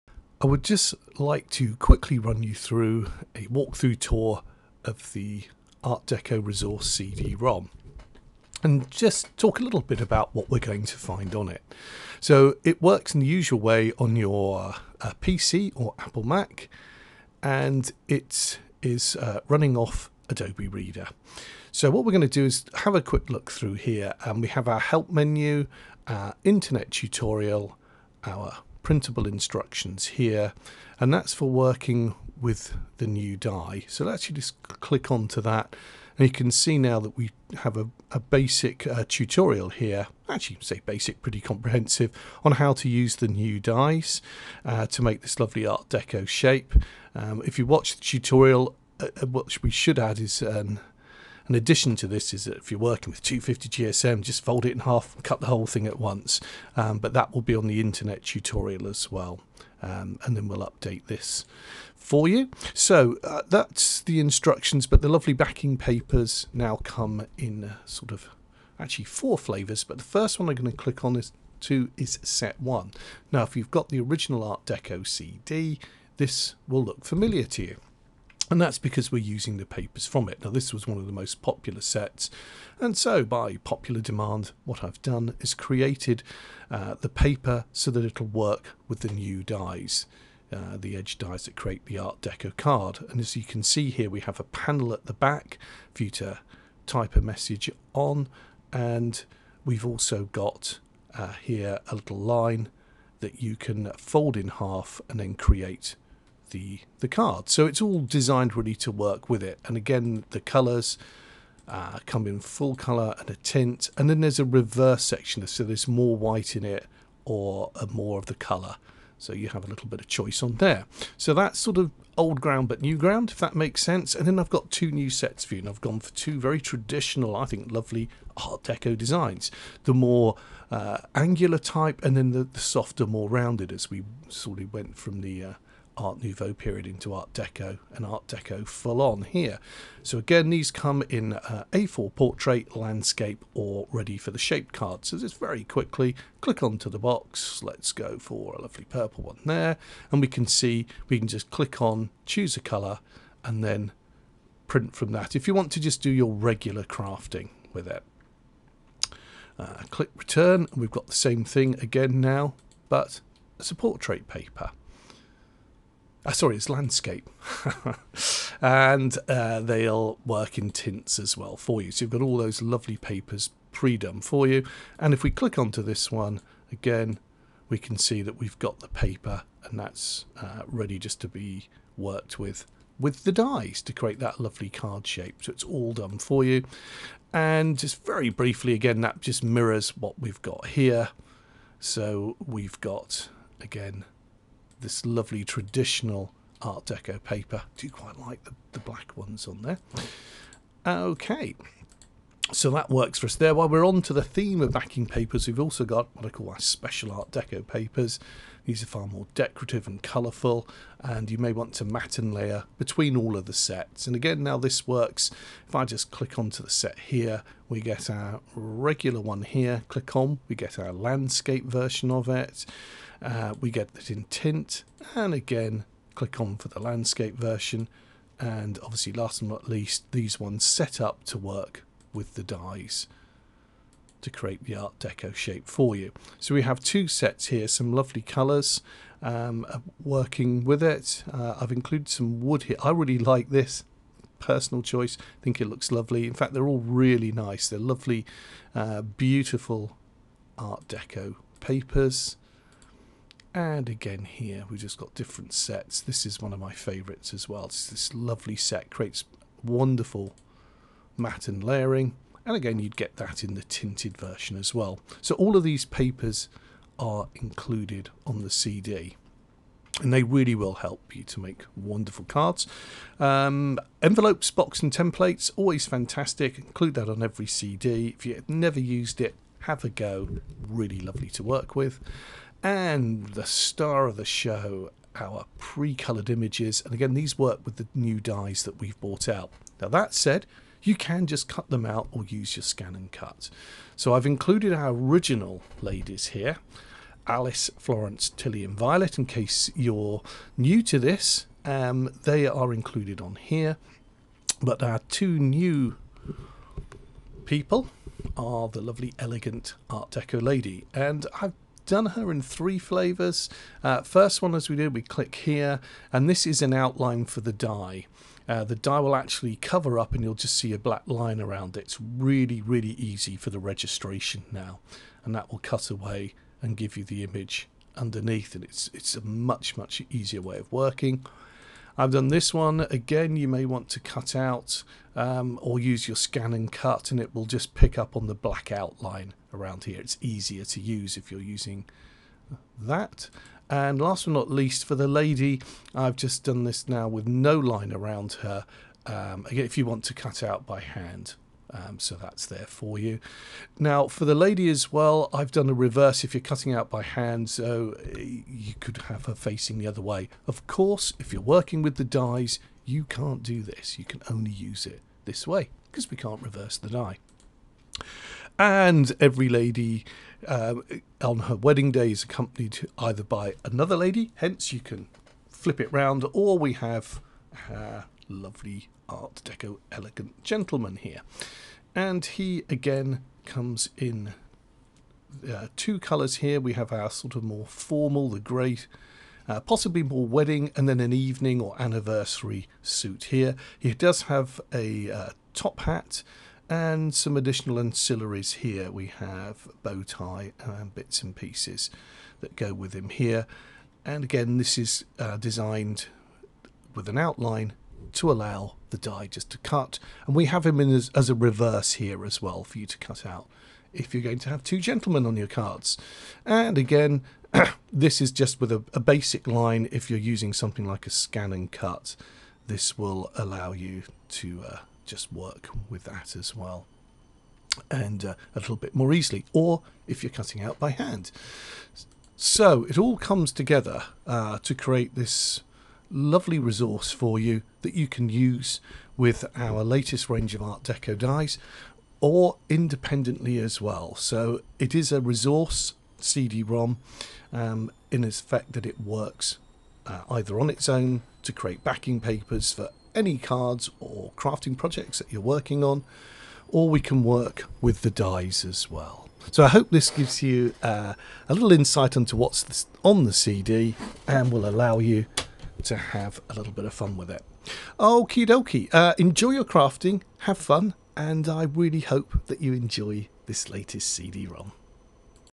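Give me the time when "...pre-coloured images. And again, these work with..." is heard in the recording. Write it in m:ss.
4:45.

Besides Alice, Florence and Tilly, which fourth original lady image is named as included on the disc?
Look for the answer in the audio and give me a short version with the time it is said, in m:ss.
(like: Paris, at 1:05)
Violet, at 4:58.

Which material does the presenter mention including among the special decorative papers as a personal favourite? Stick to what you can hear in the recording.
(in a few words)
wood.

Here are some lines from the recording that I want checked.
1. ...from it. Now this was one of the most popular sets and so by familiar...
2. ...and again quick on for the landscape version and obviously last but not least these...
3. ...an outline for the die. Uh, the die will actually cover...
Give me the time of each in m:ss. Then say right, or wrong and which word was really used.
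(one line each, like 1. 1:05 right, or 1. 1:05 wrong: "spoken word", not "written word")
1. 1:20 wrong: "popular", not "familiar"
2. 3:45 wrong: "click", not "quick"
3. 5:16 right.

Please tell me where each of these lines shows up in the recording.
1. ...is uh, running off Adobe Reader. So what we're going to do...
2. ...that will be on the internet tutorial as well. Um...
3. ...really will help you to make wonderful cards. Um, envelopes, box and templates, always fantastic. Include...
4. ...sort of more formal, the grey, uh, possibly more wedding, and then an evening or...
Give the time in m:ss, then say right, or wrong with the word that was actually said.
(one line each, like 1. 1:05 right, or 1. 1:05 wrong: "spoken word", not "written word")
1. 0:18 right
2. 0:57 right
3. 4:30 right
4. 6:27 right.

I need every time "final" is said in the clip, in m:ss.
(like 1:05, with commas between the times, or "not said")
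not said.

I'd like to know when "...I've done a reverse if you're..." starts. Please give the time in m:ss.
5:55.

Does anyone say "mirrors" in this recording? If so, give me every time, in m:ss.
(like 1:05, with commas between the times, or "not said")
3:09.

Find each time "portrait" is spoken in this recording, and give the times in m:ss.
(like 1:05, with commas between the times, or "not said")
2:22, 2:43.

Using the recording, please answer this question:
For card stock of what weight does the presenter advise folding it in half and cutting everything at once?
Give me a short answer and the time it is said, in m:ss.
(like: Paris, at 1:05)
250 GSM, at 0:53.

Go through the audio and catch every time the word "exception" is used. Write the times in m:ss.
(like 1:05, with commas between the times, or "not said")
not said.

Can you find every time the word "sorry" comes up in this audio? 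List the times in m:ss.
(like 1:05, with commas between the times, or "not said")
2:46.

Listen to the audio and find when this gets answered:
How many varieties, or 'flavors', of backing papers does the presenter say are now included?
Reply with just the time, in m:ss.
1:09.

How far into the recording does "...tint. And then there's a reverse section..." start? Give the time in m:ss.
1:53.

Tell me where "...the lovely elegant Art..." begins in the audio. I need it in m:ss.
5:08.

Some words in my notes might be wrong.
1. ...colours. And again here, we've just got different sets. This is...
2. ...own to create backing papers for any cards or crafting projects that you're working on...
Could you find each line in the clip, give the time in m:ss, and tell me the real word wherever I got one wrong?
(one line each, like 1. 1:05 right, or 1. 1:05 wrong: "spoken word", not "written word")
1. 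4:11 wrong: "papers", not "colours"
2. 7:30 right.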